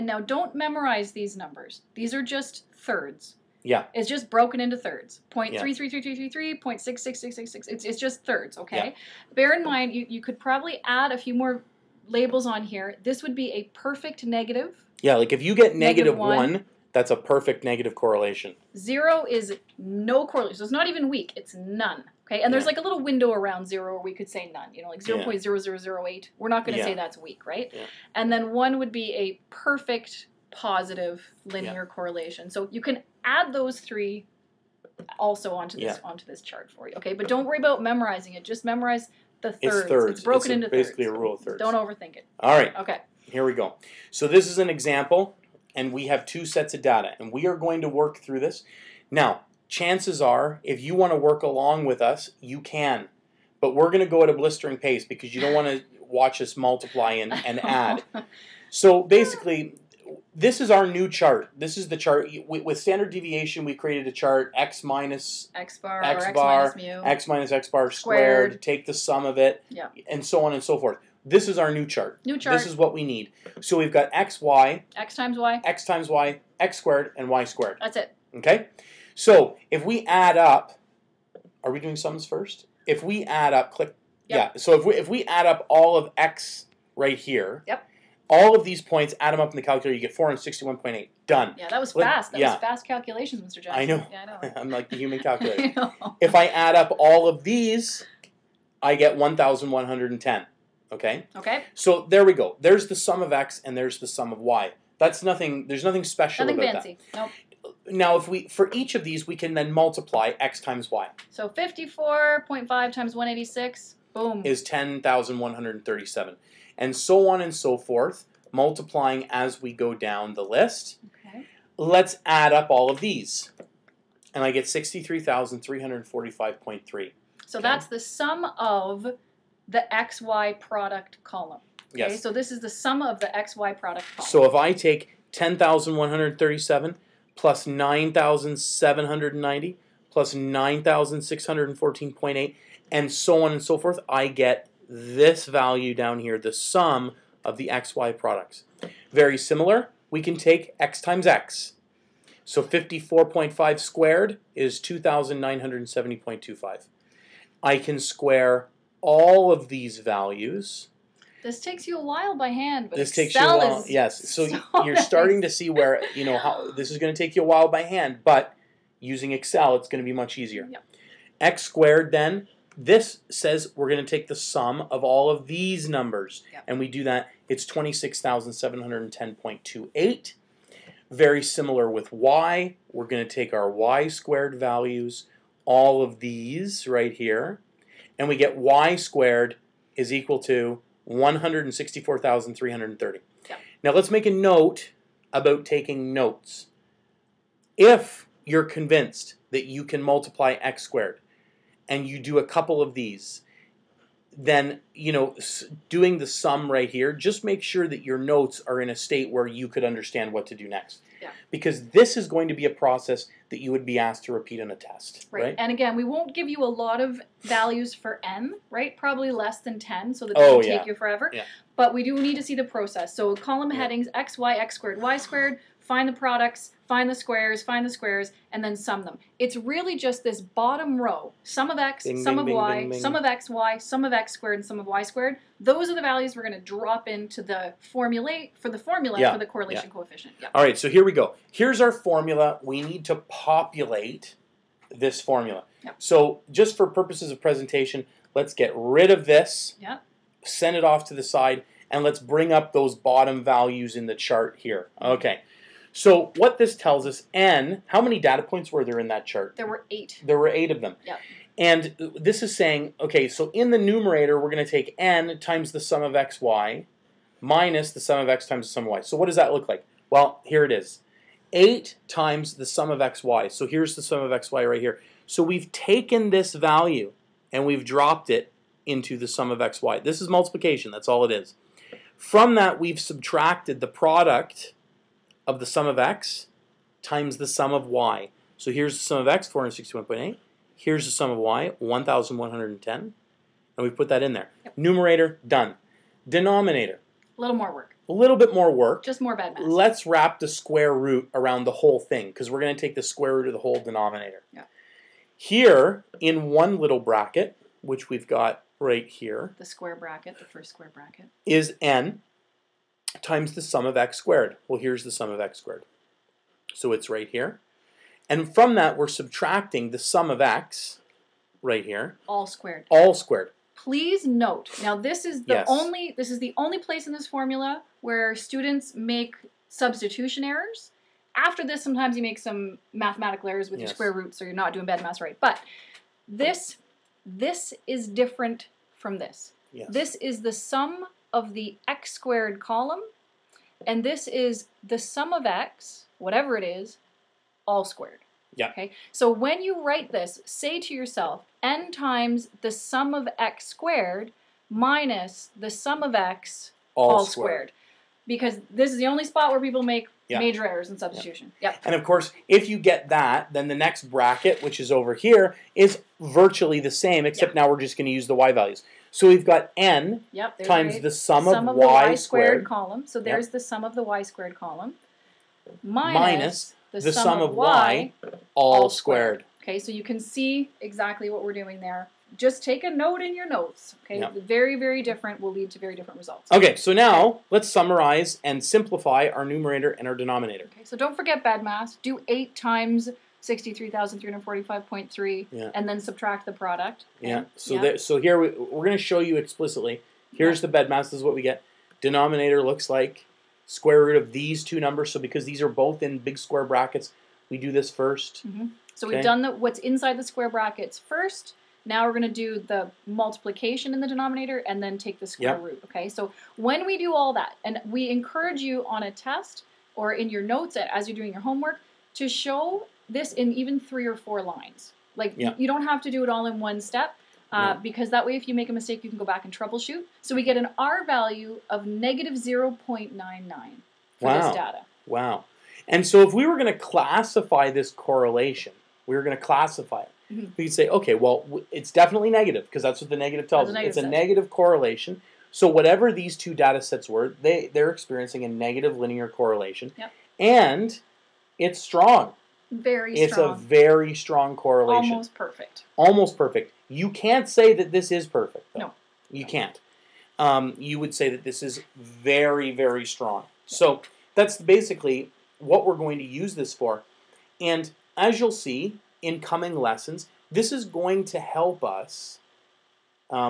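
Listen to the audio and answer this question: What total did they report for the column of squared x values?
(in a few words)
26,710.28.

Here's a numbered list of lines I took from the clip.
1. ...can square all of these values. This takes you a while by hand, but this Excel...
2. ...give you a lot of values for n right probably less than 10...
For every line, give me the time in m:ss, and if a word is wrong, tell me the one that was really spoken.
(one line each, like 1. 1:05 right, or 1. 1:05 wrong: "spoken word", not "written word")
1. 2:37 right
2. 3:36 right.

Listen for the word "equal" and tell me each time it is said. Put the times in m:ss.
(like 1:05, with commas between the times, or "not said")
3:10.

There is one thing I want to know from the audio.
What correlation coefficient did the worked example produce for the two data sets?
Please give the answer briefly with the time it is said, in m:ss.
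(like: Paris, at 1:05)
-0.99, at 7:11.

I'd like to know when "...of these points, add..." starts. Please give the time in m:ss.
1:28.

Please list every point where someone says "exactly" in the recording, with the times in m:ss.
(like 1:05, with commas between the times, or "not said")
6:20.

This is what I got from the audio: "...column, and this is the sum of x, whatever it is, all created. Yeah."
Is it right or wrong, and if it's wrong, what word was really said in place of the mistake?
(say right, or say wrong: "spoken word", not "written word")
wrong: "squared", not "created".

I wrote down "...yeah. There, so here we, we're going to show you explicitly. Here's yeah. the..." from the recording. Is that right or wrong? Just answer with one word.
right.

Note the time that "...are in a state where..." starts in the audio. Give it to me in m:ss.
3:28.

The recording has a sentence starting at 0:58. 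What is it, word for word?
So basically, this is our new chart.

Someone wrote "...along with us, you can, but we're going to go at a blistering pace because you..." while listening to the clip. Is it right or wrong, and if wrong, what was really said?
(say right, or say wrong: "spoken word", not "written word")
right.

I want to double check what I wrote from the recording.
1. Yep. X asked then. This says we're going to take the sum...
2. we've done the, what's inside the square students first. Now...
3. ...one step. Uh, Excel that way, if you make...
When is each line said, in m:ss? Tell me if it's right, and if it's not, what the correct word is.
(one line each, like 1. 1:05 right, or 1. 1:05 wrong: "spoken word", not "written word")
1. 2:50 wrong: "squared", not "asked"
2. 6:49 wrong: "brackets", not "students"
3. 7:06 wrong: "Because", not "Excel".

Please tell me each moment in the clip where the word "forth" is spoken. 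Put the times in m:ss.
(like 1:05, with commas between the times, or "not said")
1:10, 1:57, 2:23.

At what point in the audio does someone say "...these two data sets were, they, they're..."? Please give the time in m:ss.
7:26.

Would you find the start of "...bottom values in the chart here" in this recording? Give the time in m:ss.
4:12.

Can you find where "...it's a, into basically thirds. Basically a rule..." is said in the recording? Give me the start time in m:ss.
0:40.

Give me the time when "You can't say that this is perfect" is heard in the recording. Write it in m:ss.
7:36.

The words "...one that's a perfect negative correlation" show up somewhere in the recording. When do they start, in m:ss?
0:16.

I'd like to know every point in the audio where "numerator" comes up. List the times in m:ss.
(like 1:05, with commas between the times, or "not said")
4:23, 4:54, 6:29.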